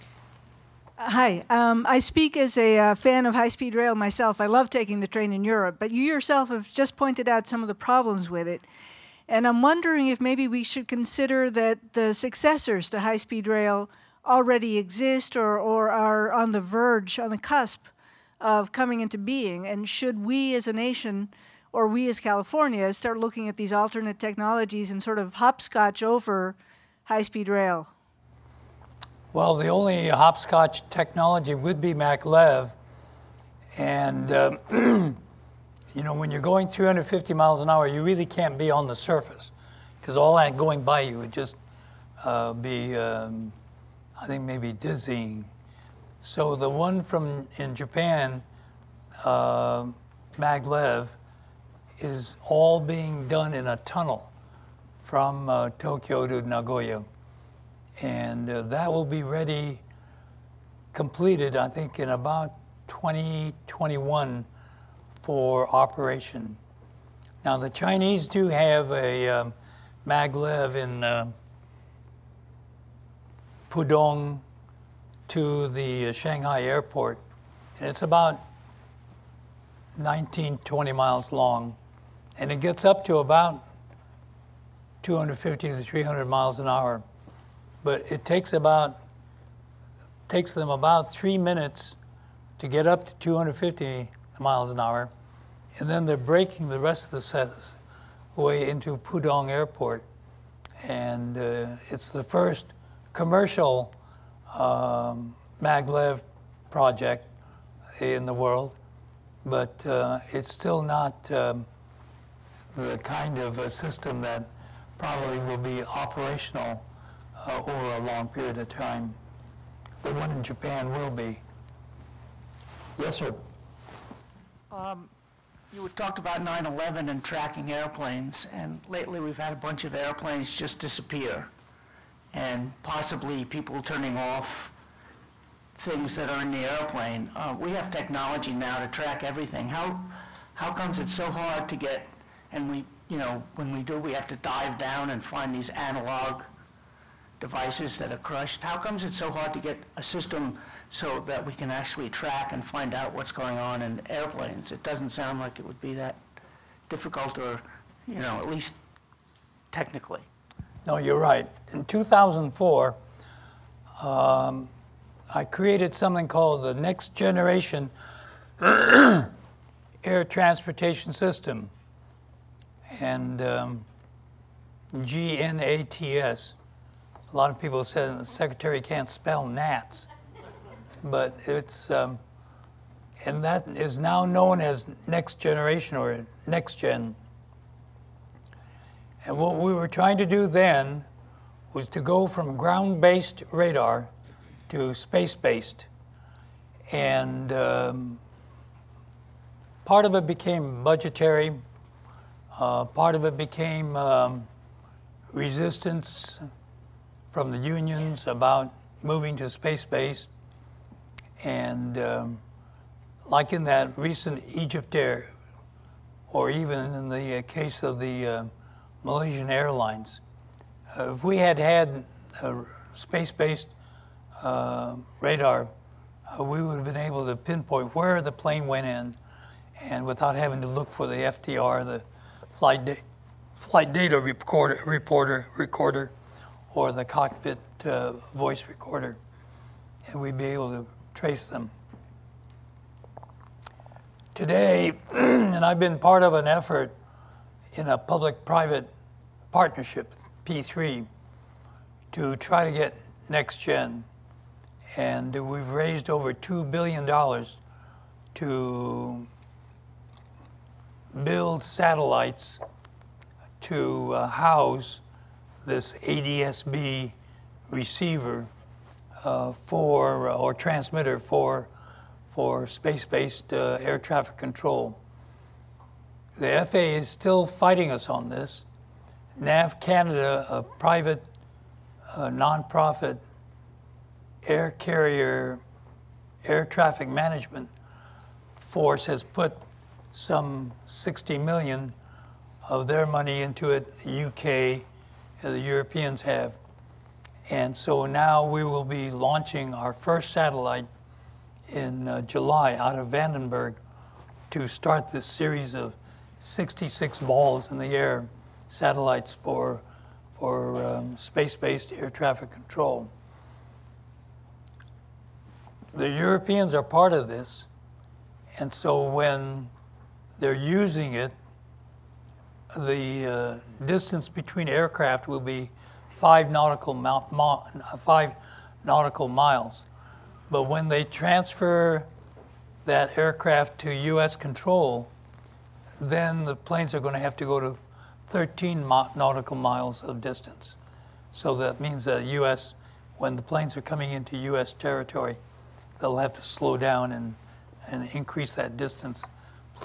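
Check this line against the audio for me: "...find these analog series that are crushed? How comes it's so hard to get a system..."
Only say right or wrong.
wrong.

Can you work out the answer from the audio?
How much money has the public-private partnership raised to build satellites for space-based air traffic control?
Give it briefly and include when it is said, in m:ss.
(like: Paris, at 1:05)
over $2 billion, at 4:16.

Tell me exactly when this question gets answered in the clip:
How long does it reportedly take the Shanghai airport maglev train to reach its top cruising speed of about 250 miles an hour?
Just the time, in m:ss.
1:31.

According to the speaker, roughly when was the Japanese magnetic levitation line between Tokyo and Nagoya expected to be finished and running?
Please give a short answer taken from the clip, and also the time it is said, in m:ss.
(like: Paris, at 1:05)
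2021, at 1:02.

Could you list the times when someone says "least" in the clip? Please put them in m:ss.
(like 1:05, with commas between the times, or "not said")
2:38.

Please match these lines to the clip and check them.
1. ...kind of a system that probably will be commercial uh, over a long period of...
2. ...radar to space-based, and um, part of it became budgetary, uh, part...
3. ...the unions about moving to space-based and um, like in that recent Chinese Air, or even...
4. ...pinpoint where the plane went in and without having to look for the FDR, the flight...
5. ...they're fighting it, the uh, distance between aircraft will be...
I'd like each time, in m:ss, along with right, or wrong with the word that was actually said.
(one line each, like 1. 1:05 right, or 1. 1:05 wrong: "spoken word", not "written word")
1. 1:52 wrong: "operational", not "commercial"
2. 3:13 right
3. 3:27 wrong: "Egypt", not "Chinese"
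4. 3:47 right
5. 5:20 wrong: "using", not "fighting".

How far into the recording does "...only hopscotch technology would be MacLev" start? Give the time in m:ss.
0:29.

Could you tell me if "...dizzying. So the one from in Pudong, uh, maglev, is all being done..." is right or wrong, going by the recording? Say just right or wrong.
wrong.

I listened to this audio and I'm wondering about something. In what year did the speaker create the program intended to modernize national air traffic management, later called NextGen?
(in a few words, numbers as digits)
2004.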